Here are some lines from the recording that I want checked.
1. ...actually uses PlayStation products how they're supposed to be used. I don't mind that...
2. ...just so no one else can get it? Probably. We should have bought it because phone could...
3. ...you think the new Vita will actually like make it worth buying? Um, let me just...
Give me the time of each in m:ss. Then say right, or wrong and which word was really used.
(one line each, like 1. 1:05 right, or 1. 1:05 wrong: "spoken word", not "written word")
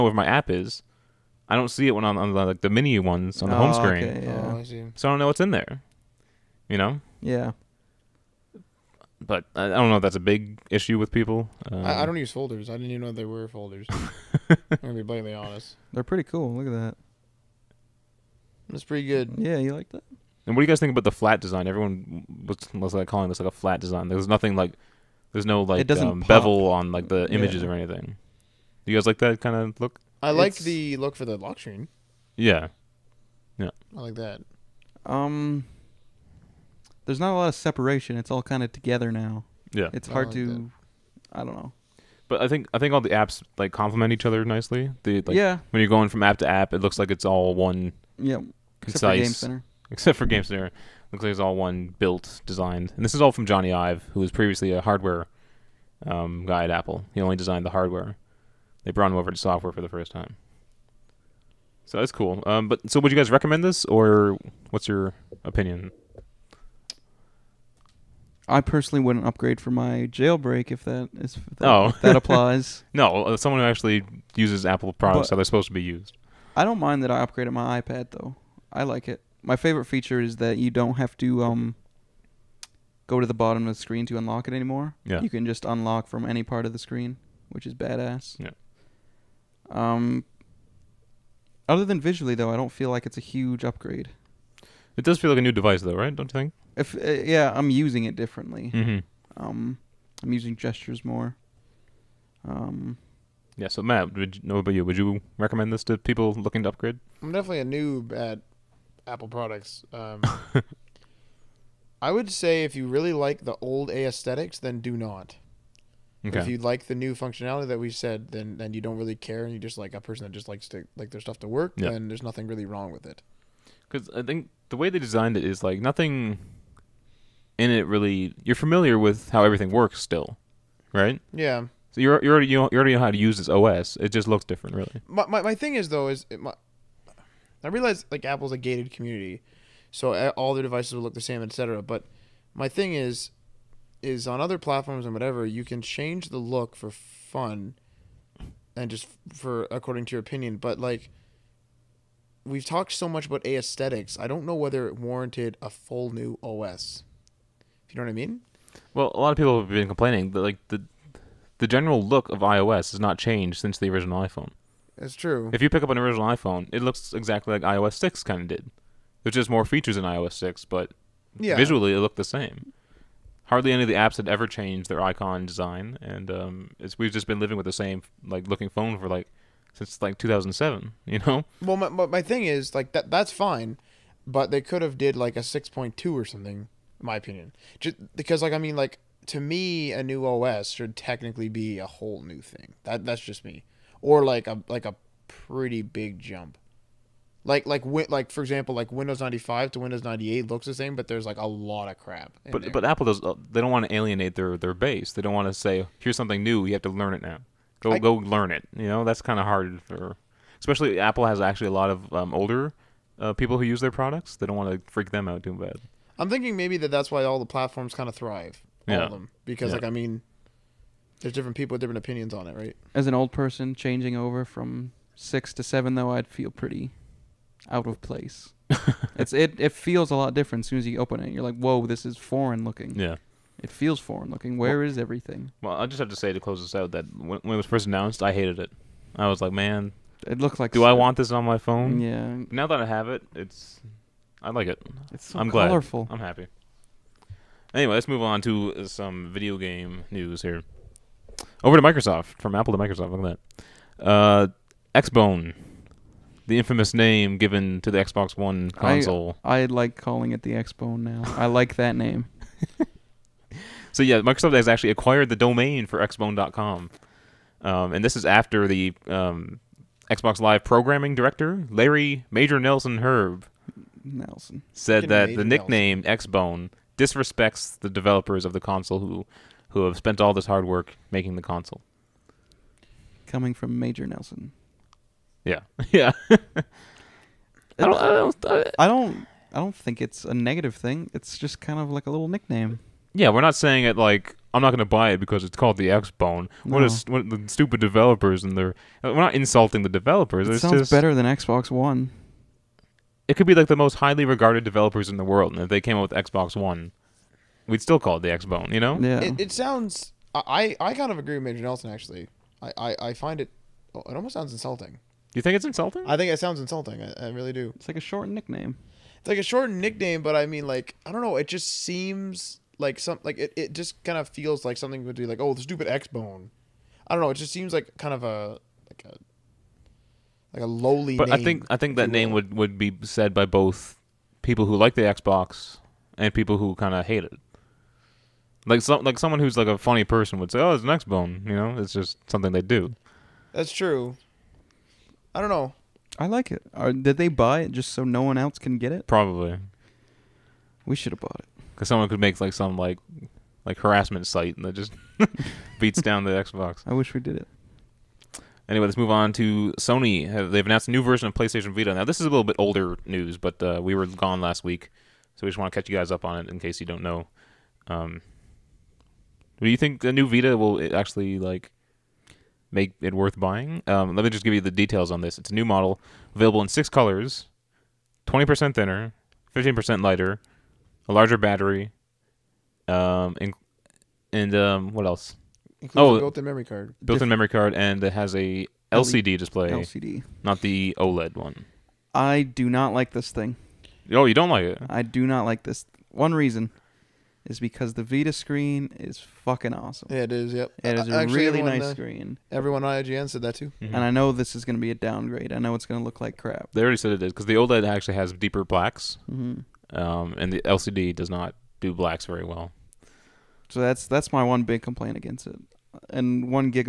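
1. 1:13 wrong: "Apple", not "PlayStation"
2. 5:47 wrong: "someone", not "phone"
3. 6:09 right.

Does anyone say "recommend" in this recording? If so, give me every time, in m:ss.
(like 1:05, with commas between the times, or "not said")
1:03, 1:45.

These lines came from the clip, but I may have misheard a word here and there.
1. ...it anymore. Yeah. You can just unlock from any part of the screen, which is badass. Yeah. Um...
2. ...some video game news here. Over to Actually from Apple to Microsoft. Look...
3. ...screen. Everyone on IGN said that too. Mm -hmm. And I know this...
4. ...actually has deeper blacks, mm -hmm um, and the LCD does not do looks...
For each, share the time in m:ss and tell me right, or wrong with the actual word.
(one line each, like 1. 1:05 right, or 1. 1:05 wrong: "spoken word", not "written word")
1. 1:24 right
2. 4:08 wrong: "Microsoft", not "Actually"
3. 6:41 right
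4. 6:47 wrong: "blacks", not "looks".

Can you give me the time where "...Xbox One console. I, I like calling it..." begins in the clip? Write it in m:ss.
4:17.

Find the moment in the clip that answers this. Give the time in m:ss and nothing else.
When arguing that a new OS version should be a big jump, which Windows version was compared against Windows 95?
3:19.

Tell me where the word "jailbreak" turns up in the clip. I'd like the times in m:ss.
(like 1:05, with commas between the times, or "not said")
1:10.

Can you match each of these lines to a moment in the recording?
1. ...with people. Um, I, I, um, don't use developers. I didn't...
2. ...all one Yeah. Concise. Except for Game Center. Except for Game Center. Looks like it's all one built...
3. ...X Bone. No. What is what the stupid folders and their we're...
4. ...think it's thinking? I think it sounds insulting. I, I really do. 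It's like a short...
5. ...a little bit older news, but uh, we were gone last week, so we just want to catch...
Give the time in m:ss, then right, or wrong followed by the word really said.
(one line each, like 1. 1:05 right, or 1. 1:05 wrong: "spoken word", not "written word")
1. 0:10 wrong: "folders", not "developers"
2. 0:47 right
3. 4:55 wrong: "developers", not "folders"
4. 5:15 wrong: "insulting", not "thinking"
5. 6:02 right.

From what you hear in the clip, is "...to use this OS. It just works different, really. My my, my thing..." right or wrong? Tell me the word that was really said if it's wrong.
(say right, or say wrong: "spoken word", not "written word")
wrong: "looks", not "works".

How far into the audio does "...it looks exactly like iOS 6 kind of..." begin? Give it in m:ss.
2:46.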